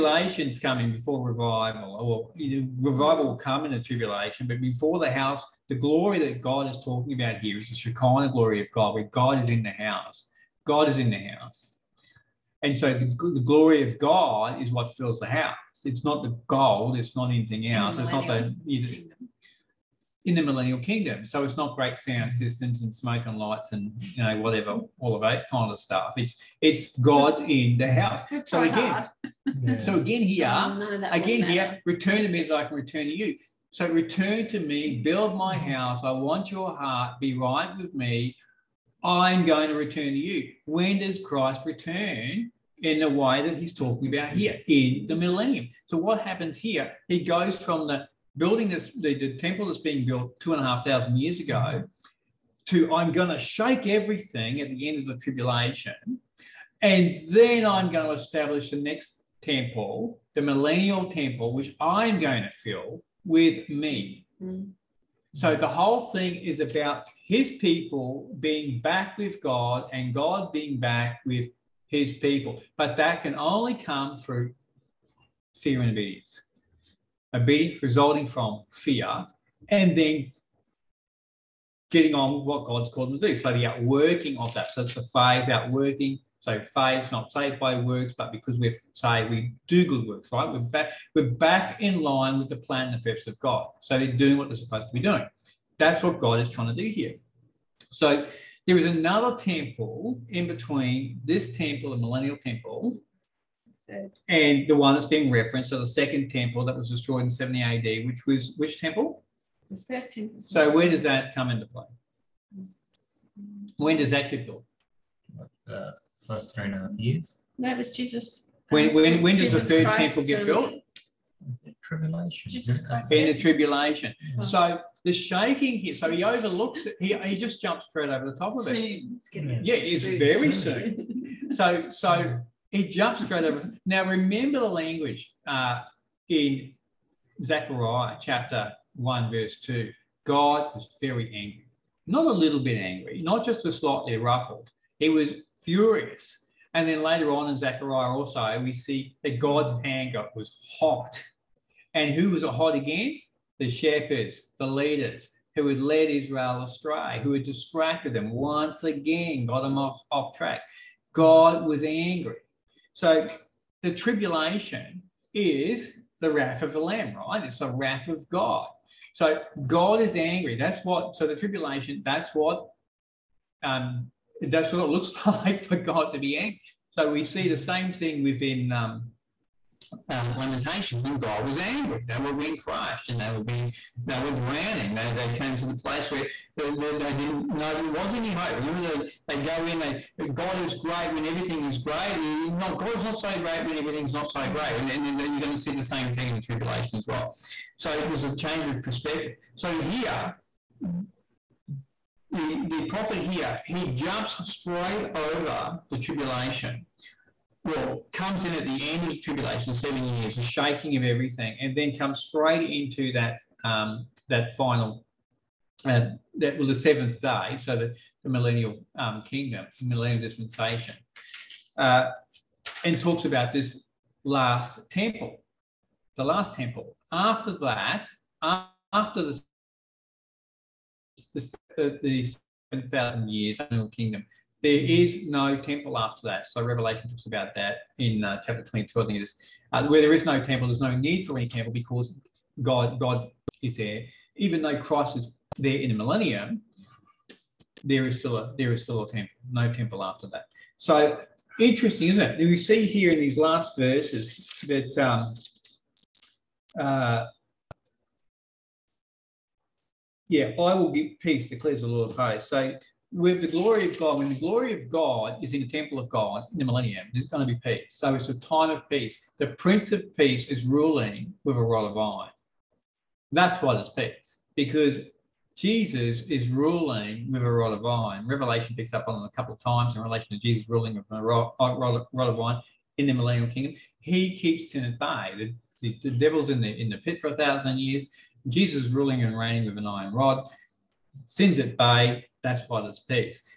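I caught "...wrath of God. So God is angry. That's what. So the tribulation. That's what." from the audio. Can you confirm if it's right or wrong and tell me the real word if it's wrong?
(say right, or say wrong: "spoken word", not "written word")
right.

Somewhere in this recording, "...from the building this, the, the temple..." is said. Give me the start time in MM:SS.
00:47.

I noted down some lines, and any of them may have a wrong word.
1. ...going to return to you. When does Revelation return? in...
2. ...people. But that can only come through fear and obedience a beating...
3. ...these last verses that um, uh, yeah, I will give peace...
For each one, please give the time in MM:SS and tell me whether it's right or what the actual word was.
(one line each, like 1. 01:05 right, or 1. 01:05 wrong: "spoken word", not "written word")
1. 00:39 wrong: "Christ", not "Revelation"
2. 01:12 right
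3. 04:13 right.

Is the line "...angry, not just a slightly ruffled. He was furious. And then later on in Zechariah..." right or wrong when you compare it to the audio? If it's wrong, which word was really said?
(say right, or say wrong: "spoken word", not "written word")
right.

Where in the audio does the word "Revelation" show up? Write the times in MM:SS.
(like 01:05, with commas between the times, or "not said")
03:56, 04:38.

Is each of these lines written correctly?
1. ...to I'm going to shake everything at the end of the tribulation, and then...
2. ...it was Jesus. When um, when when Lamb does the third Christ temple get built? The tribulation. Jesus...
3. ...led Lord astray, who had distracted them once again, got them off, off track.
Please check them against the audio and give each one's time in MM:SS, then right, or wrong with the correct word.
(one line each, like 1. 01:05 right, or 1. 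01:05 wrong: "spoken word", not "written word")
1. 00:52 right
2. 01:57 wrong: "Jesus", not "Lamb"
3. 02:35 wrong: "Israel", not "Lord".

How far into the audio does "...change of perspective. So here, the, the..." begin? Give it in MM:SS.
03:18.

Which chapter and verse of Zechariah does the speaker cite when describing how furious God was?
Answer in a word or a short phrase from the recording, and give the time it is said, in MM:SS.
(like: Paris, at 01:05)
Chapter 1, verse 2, at 02:18.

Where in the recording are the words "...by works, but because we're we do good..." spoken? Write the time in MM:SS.
01:27.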